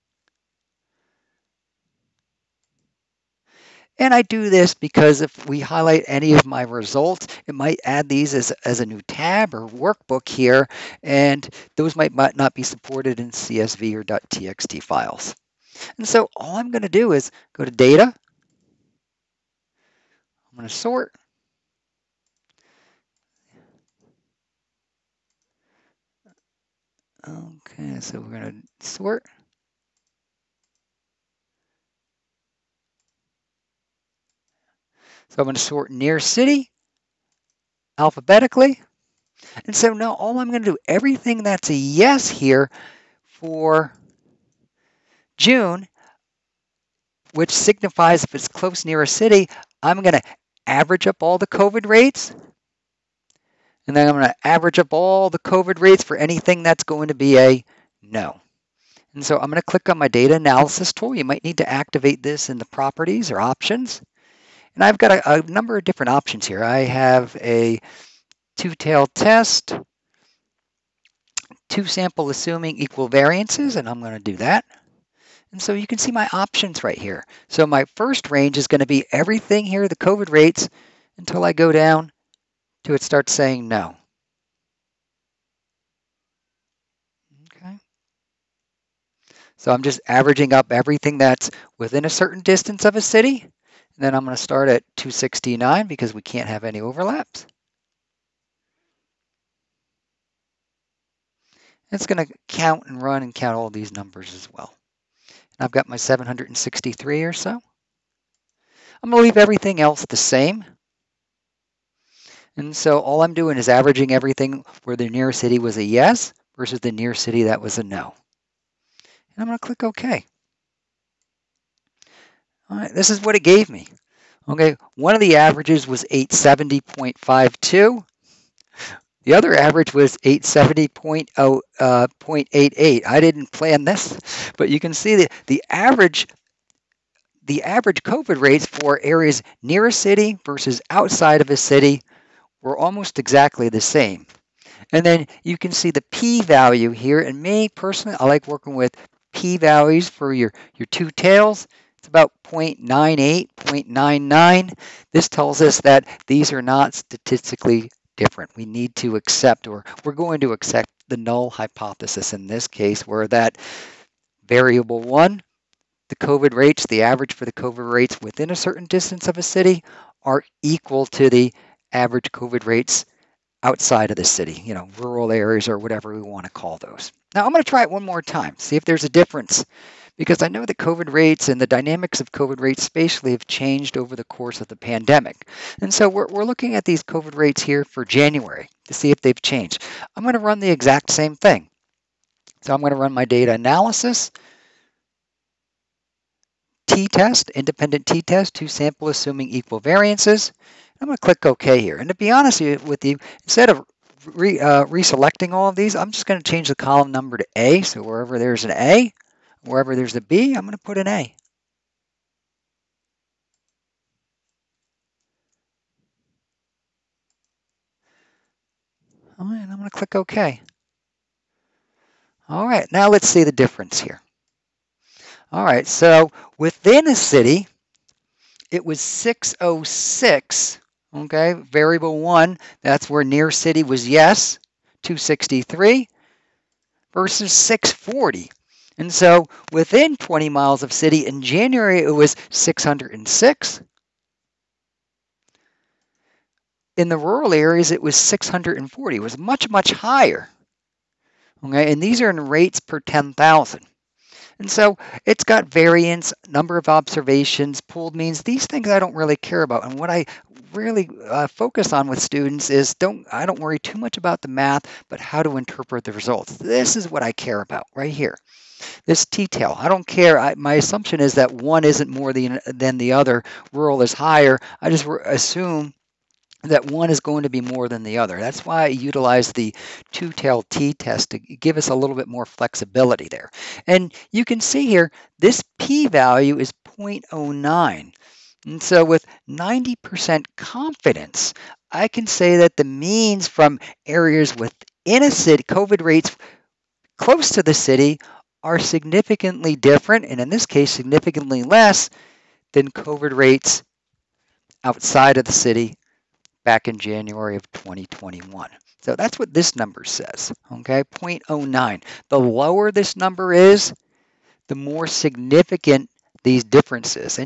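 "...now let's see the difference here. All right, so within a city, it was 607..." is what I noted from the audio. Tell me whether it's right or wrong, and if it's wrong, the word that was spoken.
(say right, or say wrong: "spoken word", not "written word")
wrong: "606", not "607".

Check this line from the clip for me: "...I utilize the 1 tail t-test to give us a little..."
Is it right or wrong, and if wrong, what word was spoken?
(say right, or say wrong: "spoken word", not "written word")
wrong: "2", not "1".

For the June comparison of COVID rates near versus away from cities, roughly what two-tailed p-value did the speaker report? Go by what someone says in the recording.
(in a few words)
0.98.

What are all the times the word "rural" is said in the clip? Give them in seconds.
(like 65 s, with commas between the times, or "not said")
174 s, 247 s, 273 s.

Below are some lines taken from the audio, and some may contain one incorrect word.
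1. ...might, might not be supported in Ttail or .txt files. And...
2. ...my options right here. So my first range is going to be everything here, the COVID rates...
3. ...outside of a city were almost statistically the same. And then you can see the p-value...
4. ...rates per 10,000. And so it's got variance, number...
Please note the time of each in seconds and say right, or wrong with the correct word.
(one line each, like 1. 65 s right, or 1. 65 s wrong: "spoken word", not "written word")
1. 11 s wrong: "CSV", not "Ttail"
2. 76 s right
3. 140 s wrong: "exactly", not "statistically"
4. 252 s right.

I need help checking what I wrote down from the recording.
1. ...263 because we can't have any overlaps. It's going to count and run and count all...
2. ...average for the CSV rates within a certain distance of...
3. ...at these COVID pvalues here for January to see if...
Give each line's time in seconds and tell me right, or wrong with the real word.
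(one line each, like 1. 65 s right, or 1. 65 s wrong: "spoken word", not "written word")
1. 94 s wrong: "269", not "263"
2. 167 s wrong: "COVID", not "CSV"
3. 186 s wrong: "rates", not "pvalues".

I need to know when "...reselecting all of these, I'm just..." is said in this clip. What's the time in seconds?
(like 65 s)
204 s.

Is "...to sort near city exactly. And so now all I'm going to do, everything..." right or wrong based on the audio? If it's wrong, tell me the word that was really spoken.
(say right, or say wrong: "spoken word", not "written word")
wrong: "alphabetically", not "exactly".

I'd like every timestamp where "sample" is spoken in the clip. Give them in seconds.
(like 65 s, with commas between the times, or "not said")
71 s, 198 s.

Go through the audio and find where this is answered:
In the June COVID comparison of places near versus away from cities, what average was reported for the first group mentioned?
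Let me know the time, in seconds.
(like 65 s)
126 s.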